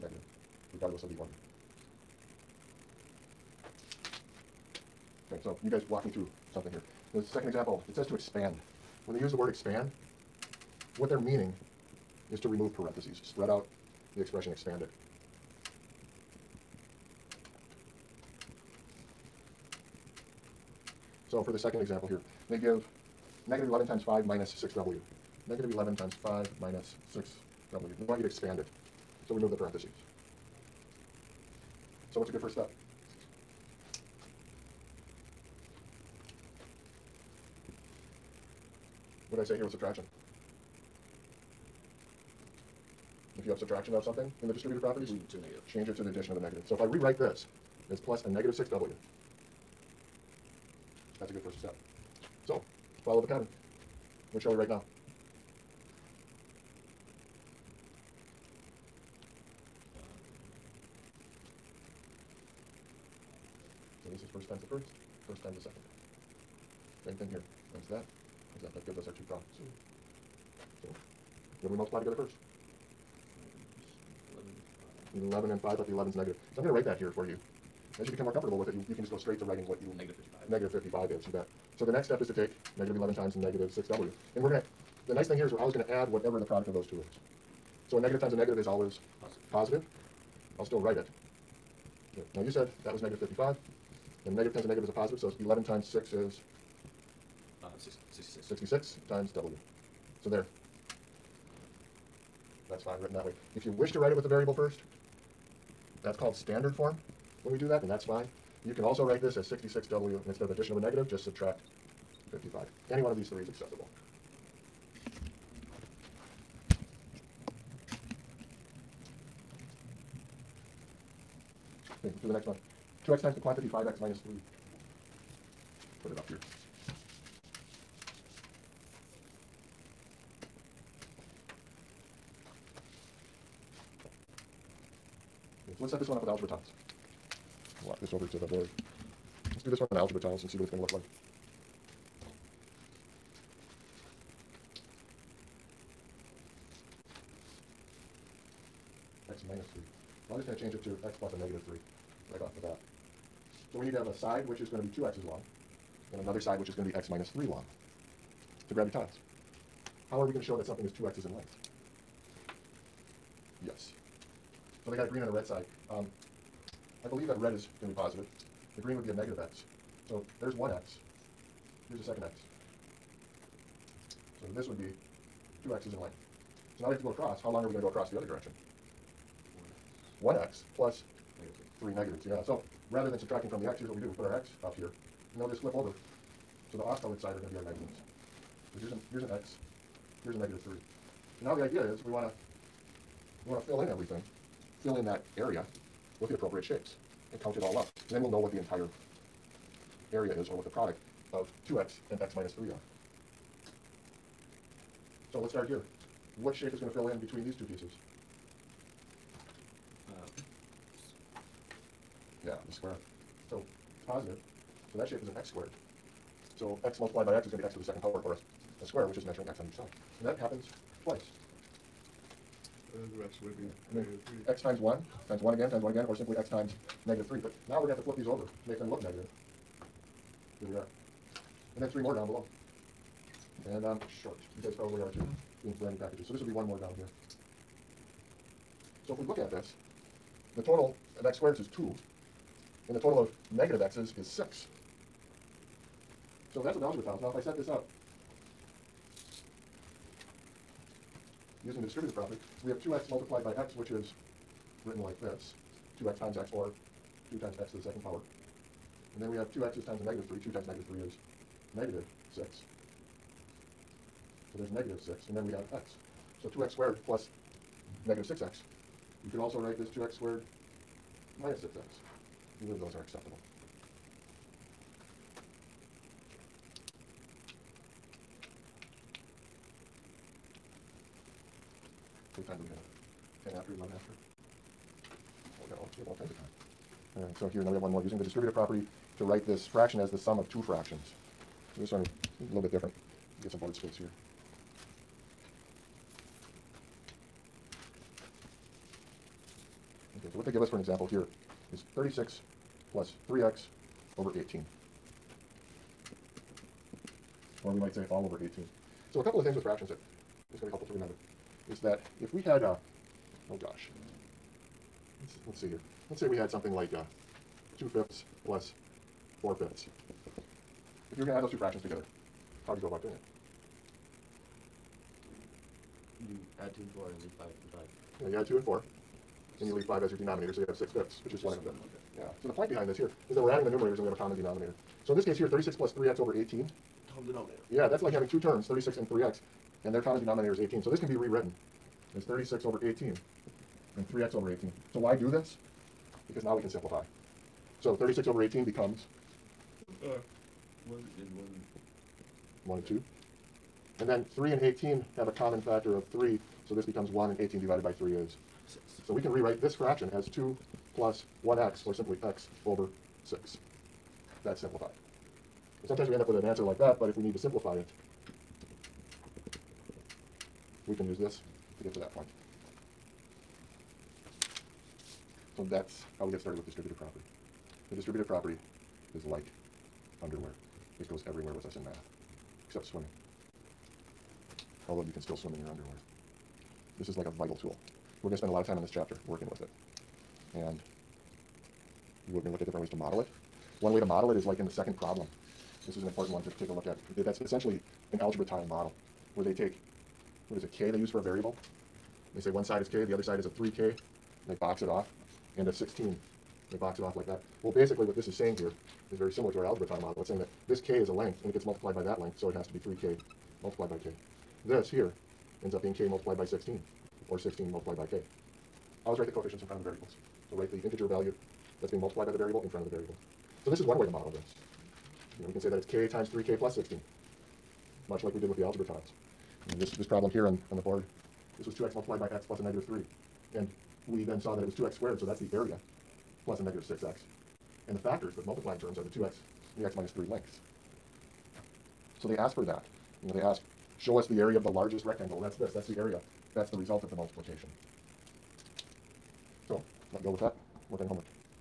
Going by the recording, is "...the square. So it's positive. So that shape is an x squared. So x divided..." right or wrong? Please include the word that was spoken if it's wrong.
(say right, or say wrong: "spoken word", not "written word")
wrong: "multiplied", not "divided".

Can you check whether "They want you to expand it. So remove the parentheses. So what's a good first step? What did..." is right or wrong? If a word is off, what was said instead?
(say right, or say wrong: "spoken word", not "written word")
right.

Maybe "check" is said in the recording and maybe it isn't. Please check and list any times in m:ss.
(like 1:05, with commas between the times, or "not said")
not said.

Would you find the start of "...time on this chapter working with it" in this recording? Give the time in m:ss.
6:28.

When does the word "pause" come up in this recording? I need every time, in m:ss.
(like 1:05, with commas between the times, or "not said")
not said.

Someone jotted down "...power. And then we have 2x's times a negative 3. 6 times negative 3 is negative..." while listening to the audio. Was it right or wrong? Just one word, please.
wrong.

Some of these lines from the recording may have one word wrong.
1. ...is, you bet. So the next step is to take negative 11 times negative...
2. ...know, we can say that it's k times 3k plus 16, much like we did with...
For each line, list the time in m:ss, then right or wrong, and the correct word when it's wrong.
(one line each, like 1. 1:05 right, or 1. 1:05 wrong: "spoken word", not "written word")
1. 1:21 right
2. 7:05 right.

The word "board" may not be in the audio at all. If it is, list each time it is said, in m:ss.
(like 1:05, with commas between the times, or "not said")
2:18, 4:53, 7:10.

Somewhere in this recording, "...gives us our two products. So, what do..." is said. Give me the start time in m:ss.
1:08.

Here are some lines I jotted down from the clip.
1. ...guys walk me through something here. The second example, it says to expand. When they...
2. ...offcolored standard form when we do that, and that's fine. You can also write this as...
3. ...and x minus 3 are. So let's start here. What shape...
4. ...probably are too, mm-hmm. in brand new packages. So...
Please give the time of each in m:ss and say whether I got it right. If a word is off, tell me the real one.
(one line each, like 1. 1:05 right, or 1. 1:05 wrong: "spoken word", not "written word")
1. 0:05 right
2. 1:46 wrong: "called", not "offcolored"
3. 3:22 right
4. 3:54 right.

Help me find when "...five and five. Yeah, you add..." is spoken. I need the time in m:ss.
5:27.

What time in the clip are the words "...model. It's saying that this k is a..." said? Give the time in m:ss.
6:50.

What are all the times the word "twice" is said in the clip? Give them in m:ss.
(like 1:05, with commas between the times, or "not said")
3:41.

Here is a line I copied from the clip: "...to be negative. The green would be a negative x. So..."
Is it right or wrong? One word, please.
wrong.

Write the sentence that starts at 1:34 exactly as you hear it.
And a negative times a negative is a positive, so 11 times 6 is?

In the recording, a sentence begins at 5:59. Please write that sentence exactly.
So we can rewrite this fraction as 2 plus 1x or simply x over six.